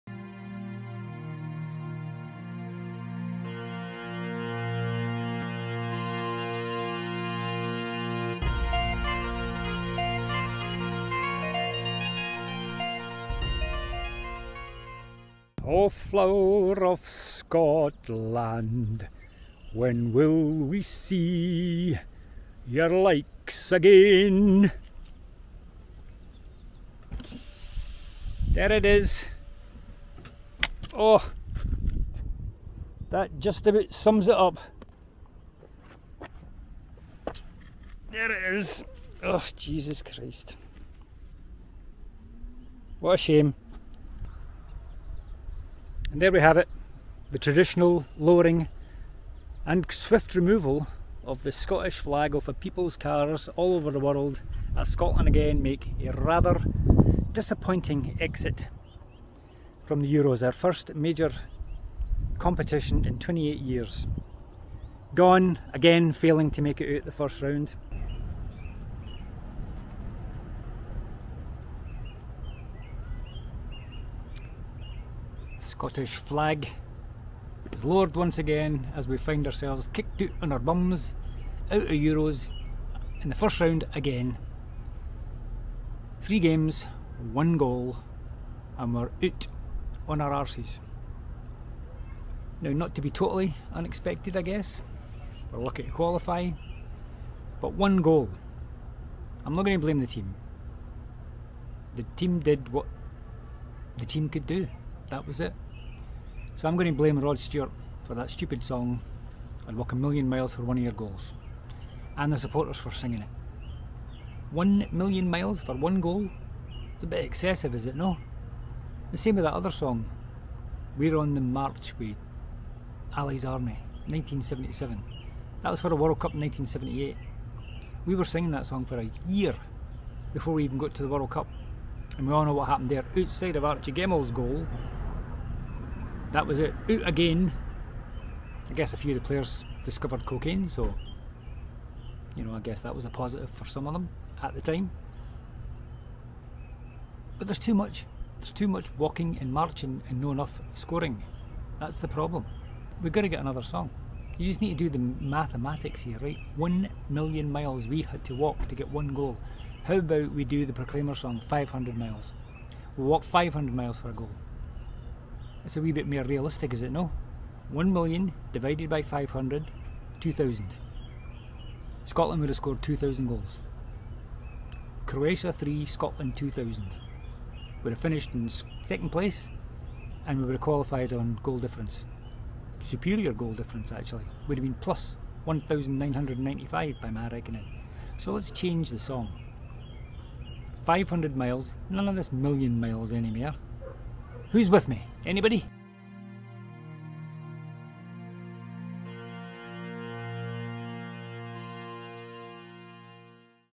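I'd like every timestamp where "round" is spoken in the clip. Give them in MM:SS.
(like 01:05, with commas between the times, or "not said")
01:07, 01:23.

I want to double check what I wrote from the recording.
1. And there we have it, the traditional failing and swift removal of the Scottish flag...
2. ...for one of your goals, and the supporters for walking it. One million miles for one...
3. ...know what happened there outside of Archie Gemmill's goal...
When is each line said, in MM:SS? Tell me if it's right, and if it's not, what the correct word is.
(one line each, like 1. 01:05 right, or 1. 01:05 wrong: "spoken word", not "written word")
1. 00:46 wrong: "lowering", not "failing"
2. 01:50 wrong: "singing", not "walking"
3. 02:12 right.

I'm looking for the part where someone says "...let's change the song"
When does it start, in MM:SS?
03:08.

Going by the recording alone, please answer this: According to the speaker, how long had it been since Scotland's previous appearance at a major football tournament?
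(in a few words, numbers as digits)
28 years.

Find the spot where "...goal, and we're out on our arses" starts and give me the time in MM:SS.
01:27.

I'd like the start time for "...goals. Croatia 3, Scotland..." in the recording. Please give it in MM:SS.
02:53.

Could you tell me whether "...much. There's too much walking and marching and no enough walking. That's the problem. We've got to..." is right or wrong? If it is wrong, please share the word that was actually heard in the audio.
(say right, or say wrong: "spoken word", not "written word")
wrong: "scoring", not "walking".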